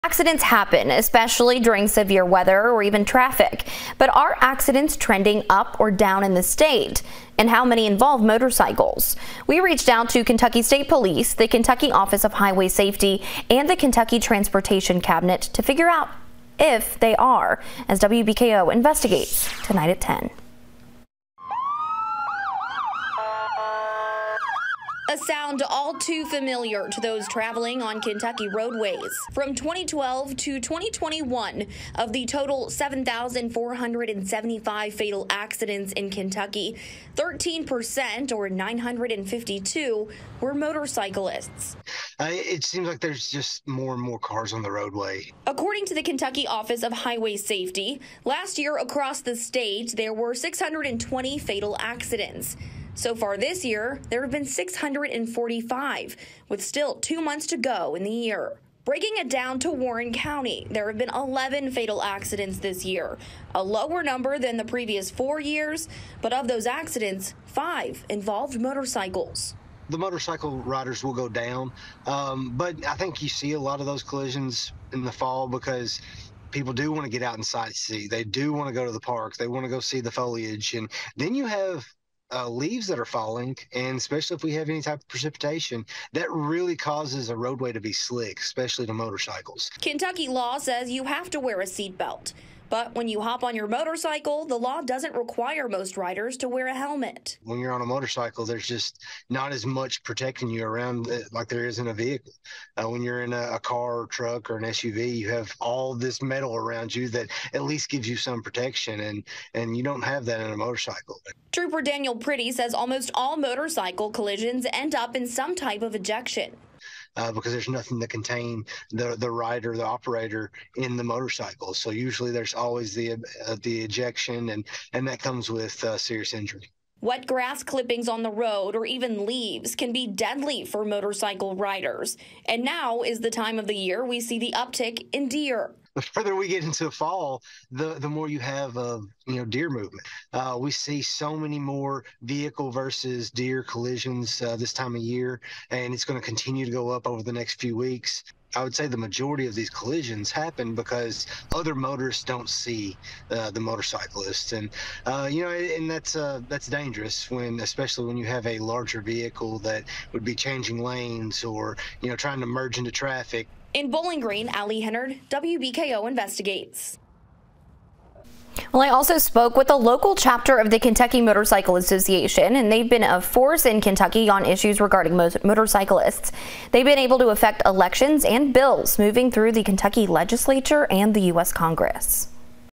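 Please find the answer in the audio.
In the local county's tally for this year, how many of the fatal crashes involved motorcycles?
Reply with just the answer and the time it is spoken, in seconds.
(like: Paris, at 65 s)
5, at 67 s.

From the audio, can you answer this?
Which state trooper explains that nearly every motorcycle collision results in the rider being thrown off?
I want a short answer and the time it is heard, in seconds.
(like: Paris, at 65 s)
Daniel Priddy, at 111 s.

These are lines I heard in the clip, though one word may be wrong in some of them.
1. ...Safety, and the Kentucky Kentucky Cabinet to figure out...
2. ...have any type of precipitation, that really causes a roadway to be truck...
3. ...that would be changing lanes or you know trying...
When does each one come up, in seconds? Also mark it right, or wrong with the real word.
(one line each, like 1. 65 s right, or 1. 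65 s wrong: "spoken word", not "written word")
1. 12 s wrong: "Transportation", not "Kentucky"
2. 84 s wrong: "slick", not "truck"
3. 159 s right.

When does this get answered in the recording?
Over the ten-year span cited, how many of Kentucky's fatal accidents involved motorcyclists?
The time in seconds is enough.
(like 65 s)
38 s.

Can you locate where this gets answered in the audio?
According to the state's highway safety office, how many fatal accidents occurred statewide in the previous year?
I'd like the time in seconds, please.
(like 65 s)
50 s.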